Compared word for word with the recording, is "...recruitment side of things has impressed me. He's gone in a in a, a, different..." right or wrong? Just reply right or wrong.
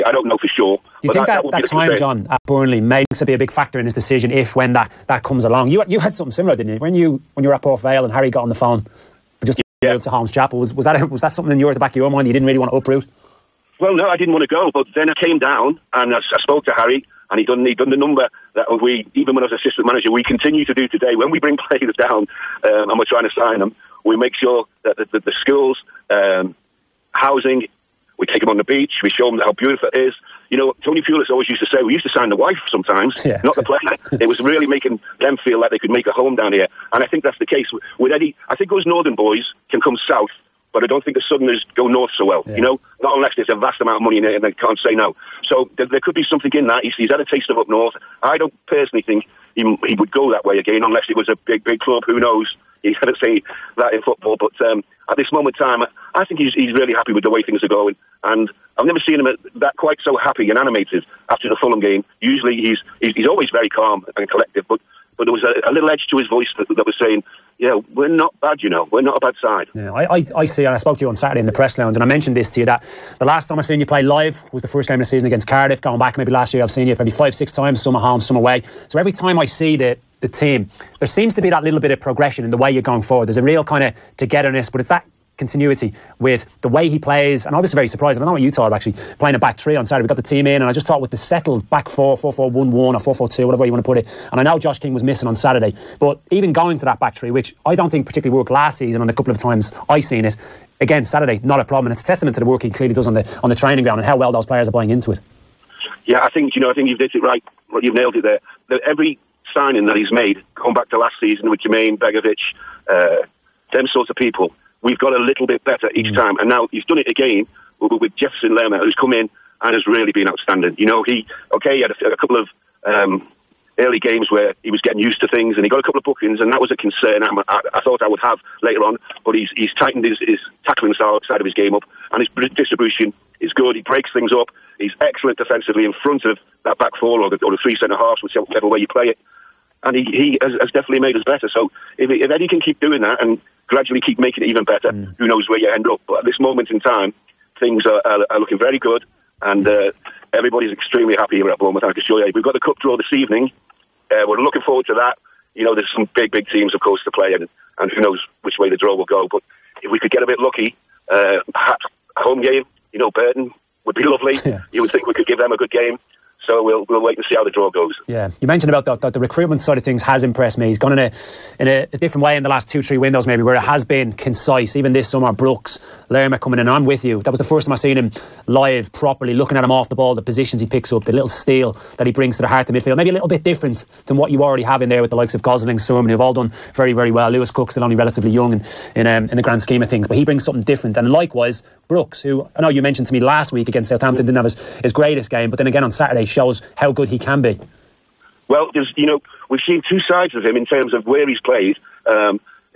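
right.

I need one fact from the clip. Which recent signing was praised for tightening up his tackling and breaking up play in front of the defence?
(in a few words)
Jefferson Lerma.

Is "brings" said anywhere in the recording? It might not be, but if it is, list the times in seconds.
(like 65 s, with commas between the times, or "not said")
21 s, 182 s, 190 s.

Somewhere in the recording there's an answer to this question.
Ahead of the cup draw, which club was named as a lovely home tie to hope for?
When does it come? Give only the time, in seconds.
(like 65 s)
163 s.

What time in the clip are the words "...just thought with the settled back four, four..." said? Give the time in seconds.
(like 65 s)
90 s.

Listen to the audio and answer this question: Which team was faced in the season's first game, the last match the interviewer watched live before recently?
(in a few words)
Cardiff.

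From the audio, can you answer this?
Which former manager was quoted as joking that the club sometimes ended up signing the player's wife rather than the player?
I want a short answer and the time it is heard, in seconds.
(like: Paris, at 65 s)
Tony Pulis, at 30 s.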